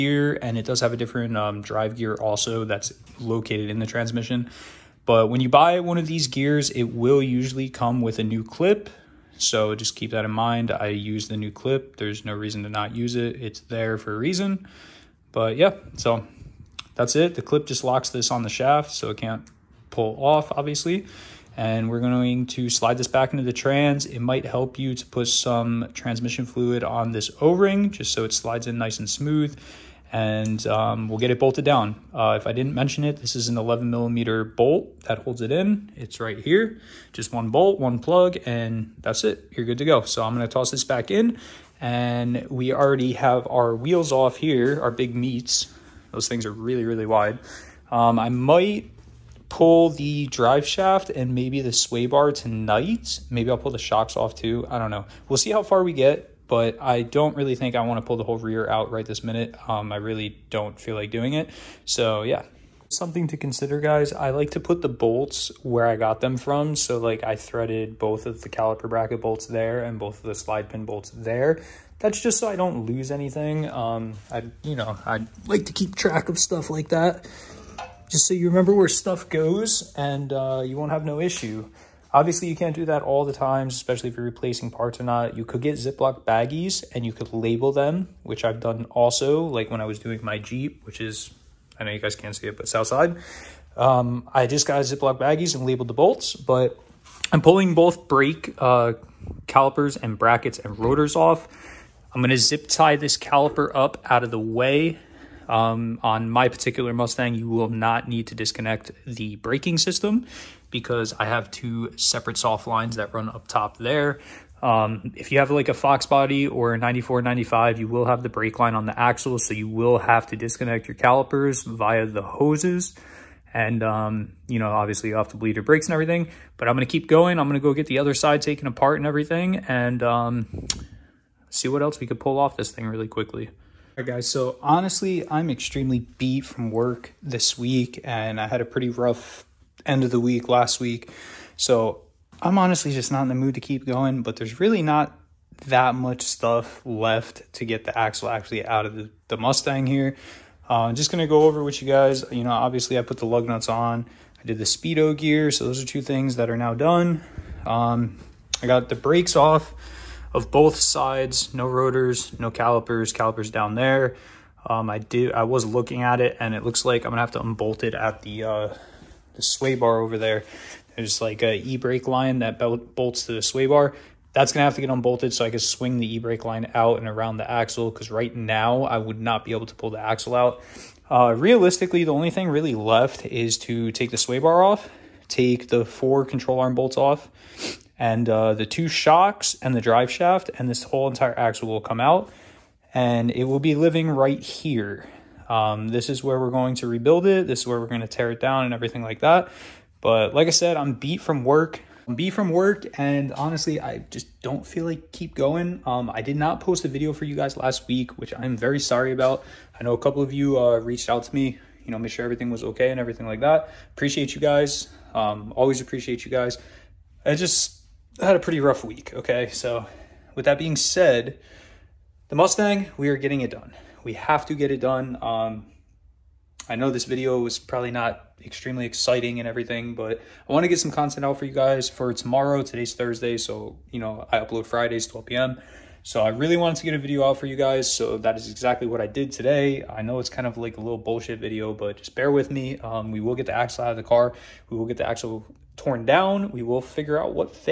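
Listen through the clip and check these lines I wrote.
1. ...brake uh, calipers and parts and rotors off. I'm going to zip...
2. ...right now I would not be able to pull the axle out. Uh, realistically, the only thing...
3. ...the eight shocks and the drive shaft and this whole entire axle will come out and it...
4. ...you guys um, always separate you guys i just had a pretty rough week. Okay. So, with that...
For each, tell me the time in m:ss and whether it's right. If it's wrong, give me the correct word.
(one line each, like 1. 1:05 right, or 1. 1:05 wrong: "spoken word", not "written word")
1. 1:38 wrong: "brackets", not "parts"
2. 2:58 right
3. 3:08 wrong: "two", not "eight"
4. 3:34 wrong: "appreciate", not "separate".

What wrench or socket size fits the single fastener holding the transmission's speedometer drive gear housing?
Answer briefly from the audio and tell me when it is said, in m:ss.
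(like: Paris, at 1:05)
11 millimeter, at 0:33.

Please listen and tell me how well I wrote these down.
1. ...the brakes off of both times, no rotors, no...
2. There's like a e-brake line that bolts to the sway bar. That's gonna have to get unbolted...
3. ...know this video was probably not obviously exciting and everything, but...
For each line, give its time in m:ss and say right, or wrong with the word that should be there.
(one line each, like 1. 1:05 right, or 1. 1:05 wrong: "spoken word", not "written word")
1. 2:38 wrong: "sides", not "times"
2. 2:50 right
3. 3:46 wrong: "extremely", not "obviously".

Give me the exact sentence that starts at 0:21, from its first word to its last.
And we're going to slide this back into the trans.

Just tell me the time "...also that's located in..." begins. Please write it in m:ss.
0:02.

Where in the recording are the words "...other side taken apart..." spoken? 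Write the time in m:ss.
2:07.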